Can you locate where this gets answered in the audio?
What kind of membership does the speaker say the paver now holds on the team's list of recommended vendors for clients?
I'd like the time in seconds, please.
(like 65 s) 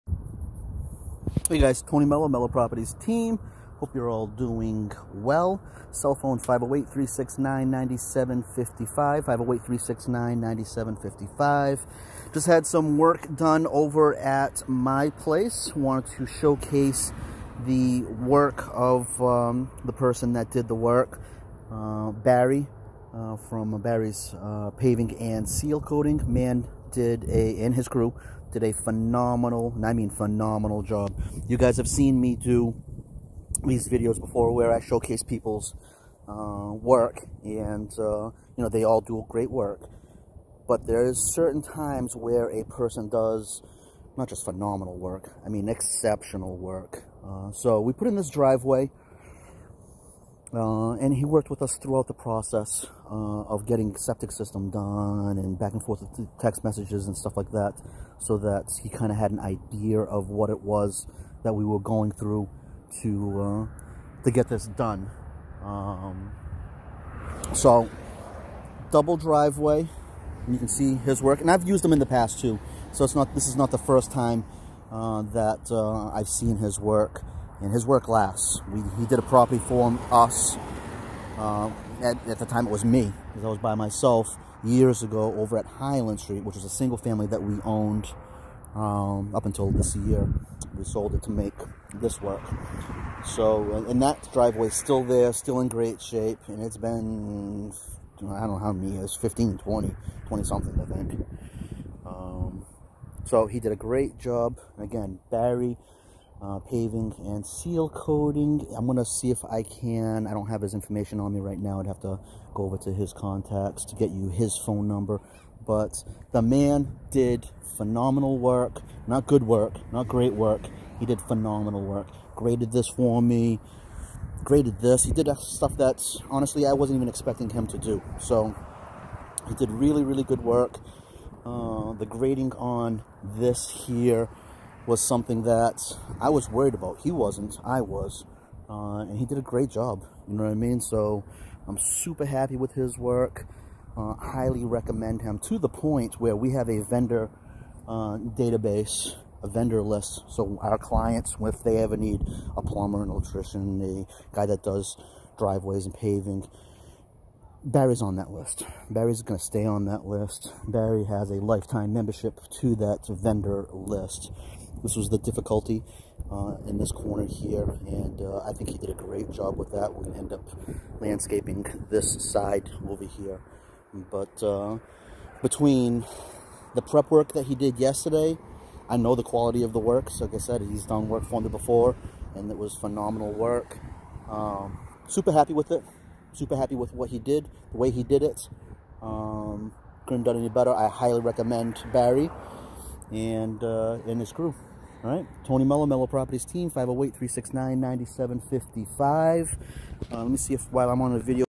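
161 s.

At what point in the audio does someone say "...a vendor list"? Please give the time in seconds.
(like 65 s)
149 s.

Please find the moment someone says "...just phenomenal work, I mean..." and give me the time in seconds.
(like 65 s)
44 s.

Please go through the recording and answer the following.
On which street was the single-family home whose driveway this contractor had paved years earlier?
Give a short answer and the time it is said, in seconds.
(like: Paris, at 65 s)
Highland Street, at 85 s.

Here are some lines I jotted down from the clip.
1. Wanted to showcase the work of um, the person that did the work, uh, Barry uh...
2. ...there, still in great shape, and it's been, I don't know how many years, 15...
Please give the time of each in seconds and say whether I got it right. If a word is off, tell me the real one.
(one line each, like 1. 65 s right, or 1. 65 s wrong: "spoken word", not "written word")
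1. 15 s right
2. 95 s right.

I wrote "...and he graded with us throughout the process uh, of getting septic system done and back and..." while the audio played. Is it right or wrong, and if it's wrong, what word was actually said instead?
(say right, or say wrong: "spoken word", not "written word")
wrong: "worked", not "graded".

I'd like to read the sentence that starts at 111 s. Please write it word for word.
I'd have to go over to his contacts to get you his phone number.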